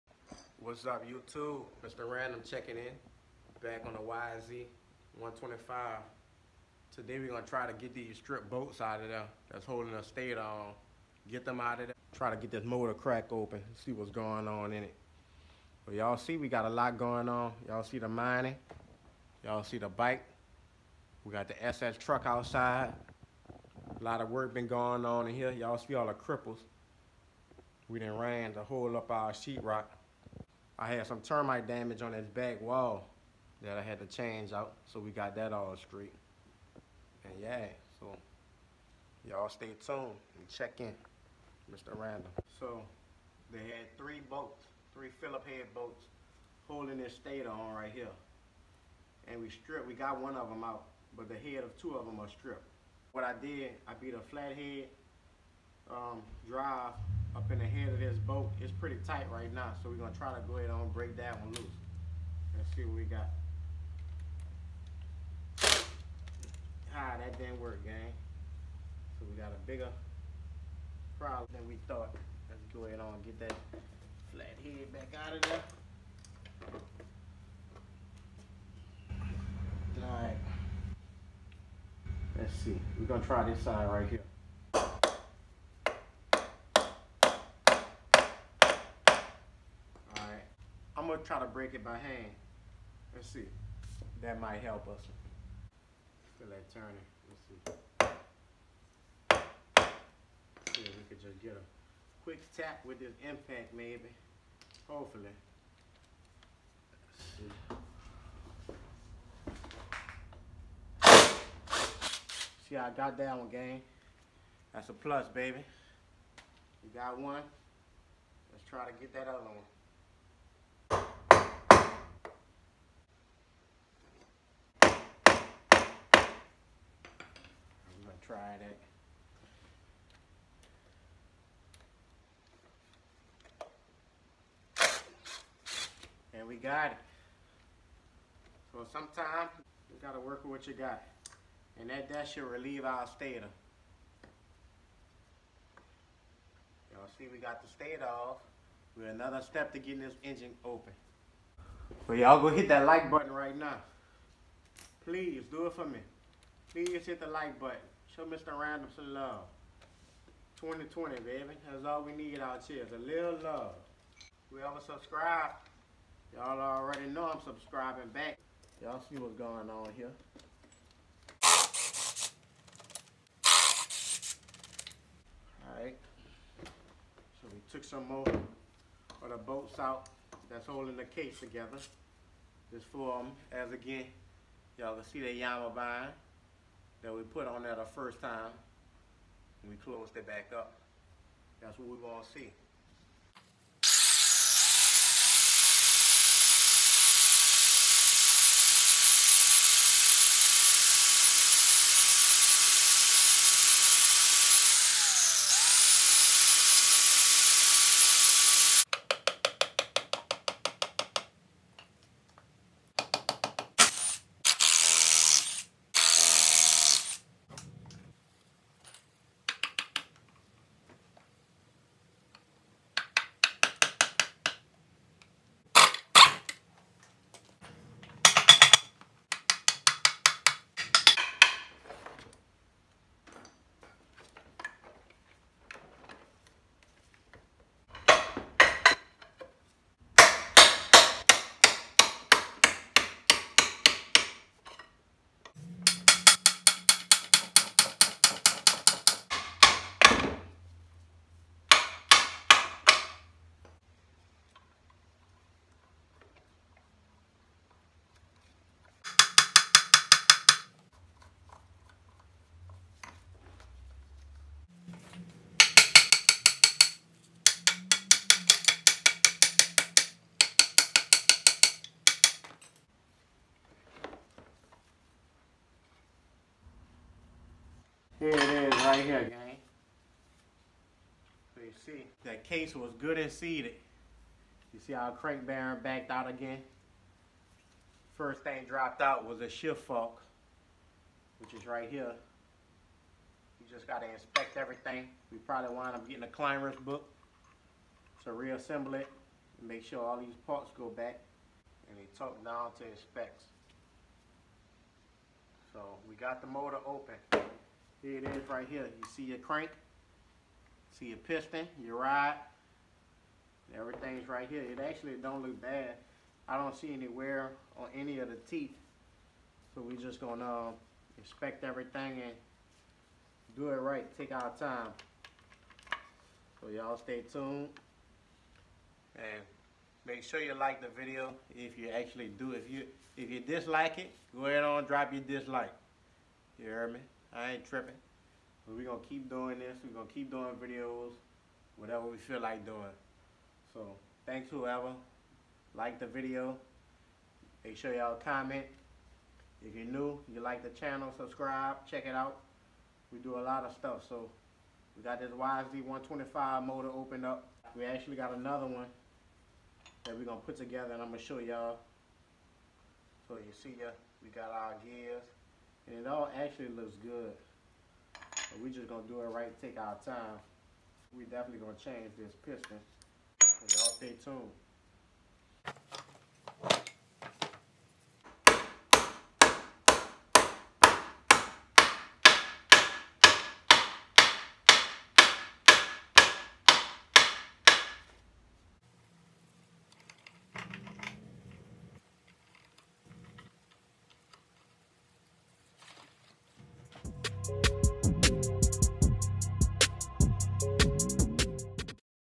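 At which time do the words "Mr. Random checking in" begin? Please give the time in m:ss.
0:01.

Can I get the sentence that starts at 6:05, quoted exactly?
And it all actually looks good.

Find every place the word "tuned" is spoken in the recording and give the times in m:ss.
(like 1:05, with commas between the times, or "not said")
0:39, 5:27, 6:14.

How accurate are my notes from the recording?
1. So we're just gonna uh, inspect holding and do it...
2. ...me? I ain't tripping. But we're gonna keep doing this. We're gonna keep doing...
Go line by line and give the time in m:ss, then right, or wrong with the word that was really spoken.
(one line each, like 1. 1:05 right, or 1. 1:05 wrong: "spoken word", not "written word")
1. 5:19 wrong: "everything", not "holding"
2. 5:36 right.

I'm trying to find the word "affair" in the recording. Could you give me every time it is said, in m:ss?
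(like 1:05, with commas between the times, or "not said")
not said.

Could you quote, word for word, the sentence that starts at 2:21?
And that, that should relieve our stator.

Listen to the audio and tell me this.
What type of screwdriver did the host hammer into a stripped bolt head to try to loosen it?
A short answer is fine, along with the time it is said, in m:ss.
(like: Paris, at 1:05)
flathead, at 0:54.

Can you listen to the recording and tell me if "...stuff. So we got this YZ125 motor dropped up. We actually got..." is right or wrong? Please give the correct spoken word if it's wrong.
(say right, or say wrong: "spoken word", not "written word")
wrong: "opened", not "dropped".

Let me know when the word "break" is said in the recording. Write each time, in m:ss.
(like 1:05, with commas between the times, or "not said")
1:00, 1:31.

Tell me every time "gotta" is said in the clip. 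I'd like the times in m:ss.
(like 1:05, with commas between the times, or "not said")
2:20, 4:53.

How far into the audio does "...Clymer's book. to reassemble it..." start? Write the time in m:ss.
4:56.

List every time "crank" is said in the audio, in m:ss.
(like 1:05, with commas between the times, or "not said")
4:45, 5:09.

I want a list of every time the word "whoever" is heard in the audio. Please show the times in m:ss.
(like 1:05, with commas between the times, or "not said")
2:44, 5:44.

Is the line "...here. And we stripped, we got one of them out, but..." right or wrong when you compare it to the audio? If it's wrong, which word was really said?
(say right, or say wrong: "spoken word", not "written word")
right.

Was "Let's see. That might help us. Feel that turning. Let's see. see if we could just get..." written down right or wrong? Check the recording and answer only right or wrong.
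right.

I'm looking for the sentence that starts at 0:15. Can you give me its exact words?
But y'all see we got a lot going on.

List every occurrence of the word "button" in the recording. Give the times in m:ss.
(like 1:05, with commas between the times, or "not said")
2:33, 2:37.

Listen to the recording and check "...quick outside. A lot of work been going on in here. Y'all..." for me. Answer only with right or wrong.
wrong.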